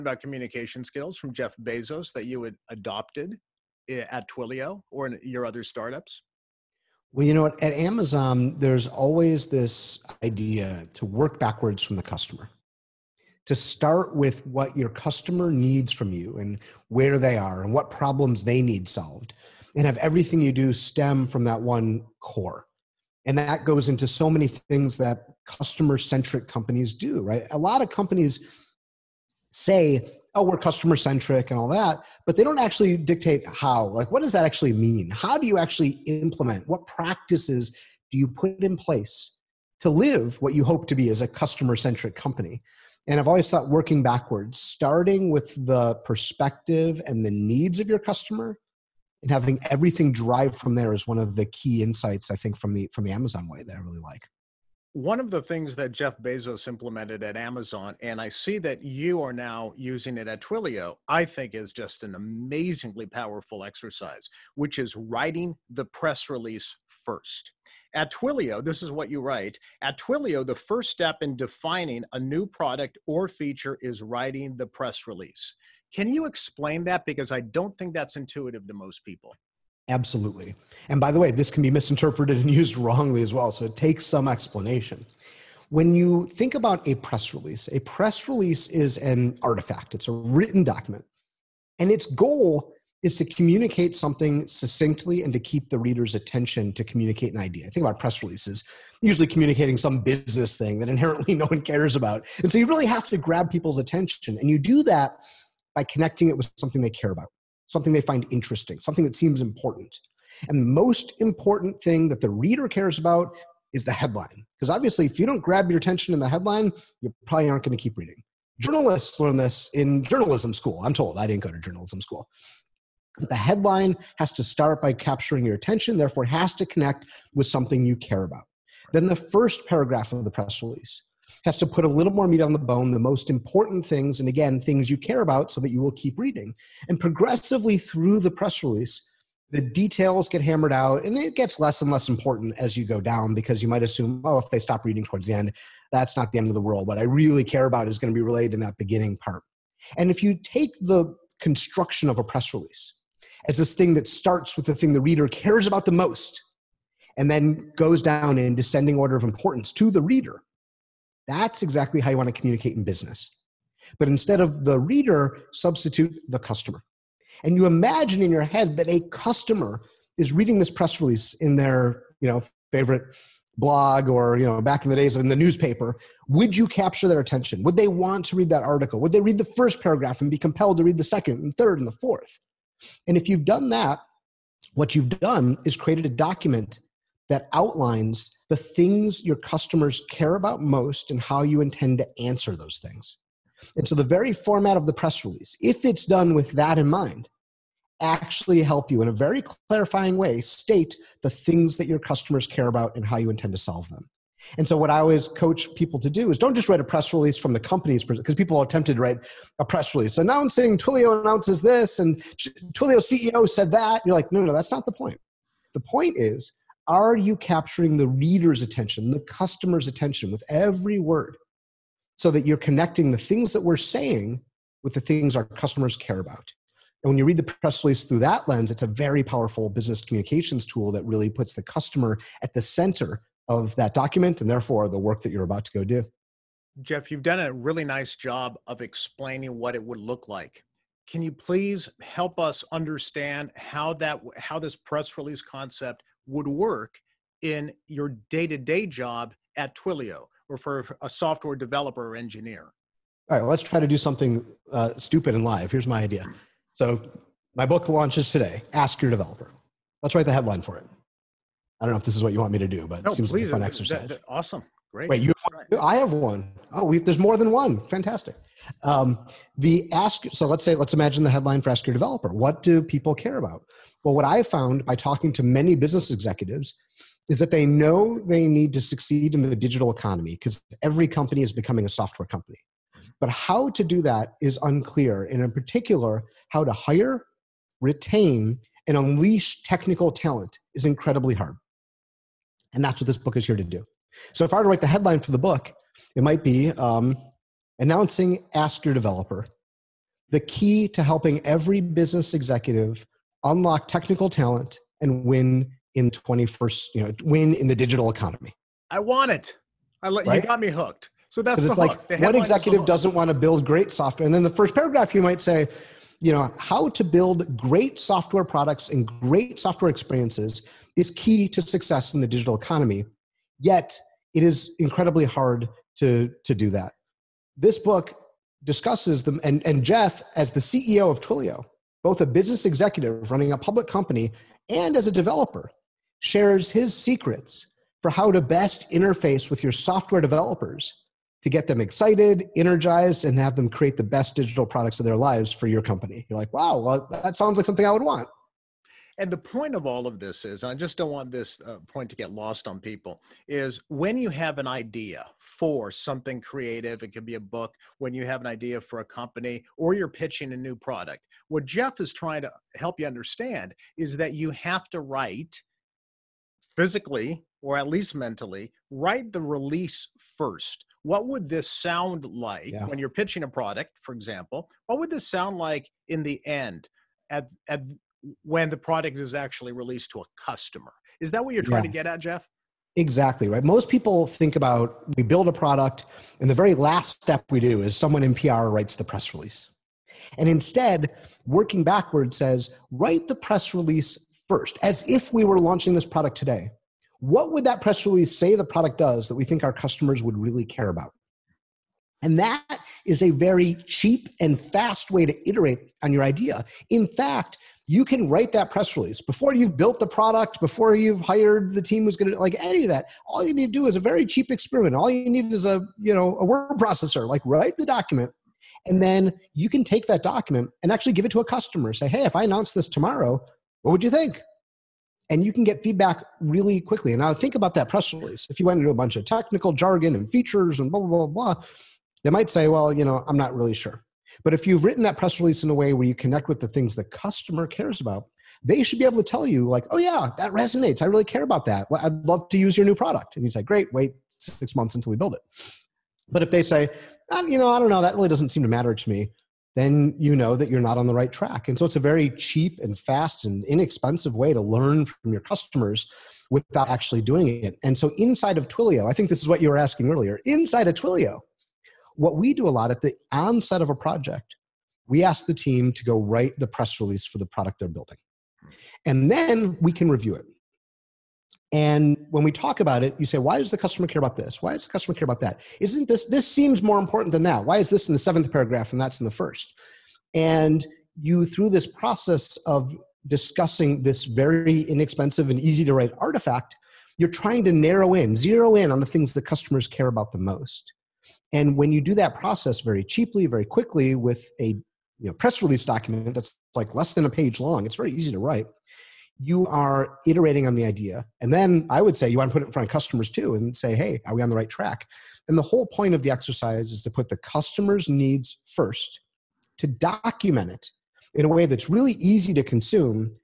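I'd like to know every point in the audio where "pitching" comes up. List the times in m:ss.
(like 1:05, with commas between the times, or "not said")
6:00, 6:13.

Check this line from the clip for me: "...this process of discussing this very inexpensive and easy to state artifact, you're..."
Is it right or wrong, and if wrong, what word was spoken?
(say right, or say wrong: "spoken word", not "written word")
wrong: "write", not "state".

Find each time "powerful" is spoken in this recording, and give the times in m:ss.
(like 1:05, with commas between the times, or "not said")
1:03, 3:49.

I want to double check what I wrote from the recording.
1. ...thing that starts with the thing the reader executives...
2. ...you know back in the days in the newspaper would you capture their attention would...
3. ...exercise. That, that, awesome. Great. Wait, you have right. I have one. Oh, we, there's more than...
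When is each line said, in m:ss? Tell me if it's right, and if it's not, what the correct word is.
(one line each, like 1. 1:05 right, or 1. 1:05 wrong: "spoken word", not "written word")
1. 2:33 wrong: "cares", not "executives"
2. 2:54 right
3. 4:23 right.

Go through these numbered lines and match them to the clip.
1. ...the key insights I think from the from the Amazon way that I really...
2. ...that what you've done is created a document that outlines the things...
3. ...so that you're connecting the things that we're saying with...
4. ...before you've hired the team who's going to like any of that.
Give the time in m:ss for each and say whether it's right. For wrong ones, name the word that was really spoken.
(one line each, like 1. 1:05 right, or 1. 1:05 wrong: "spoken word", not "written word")
1. 0:51 right
2. 3:03 right
3. 3:42 right
4. 6:50 right.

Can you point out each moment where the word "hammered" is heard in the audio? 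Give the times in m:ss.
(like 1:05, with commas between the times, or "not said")
2:20.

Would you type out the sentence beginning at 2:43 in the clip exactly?
But instead of the reader, substitute the customer.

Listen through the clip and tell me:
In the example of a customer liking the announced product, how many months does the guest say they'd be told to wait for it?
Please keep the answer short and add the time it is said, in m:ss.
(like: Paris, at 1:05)
6, at 7:24.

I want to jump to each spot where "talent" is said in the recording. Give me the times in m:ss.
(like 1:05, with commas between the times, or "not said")
4:50, 5:04.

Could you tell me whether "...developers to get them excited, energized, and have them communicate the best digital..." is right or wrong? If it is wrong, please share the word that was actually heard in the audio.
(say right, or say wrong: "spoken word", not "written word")
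wrong: "create", not "communicate".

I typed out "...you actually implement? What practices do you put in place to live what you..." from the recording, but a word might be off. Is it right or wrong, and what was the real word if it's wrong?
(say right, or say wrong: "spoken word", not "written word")
right.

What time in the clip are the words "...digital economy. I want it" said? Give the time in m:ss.
5:07.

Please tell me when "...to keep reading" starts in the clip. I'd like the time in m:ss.
1:57.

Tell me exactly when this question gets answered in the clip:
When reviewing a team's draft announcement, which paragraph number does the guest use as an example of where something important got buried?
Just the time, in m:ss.
7:58.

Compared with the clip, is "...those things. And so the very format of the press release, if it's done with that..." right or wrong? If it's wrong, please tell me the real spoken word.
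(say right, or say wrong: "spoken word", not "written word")
right.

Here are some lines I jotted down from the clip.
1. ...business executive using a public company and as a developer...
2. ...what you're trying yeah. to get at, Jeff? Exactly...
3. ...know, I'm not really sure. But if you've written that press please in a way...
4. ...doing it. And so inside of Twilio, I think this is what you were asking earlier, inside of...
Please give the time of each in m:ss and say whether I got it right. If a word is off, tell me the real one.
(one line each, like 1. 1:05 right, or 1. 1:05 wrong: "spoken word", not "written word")
1. 5:32 wrong: "running", not "using"
2. 6:21 right
3. 7:13 wrong: "release", not "please"
4. 7:37 right.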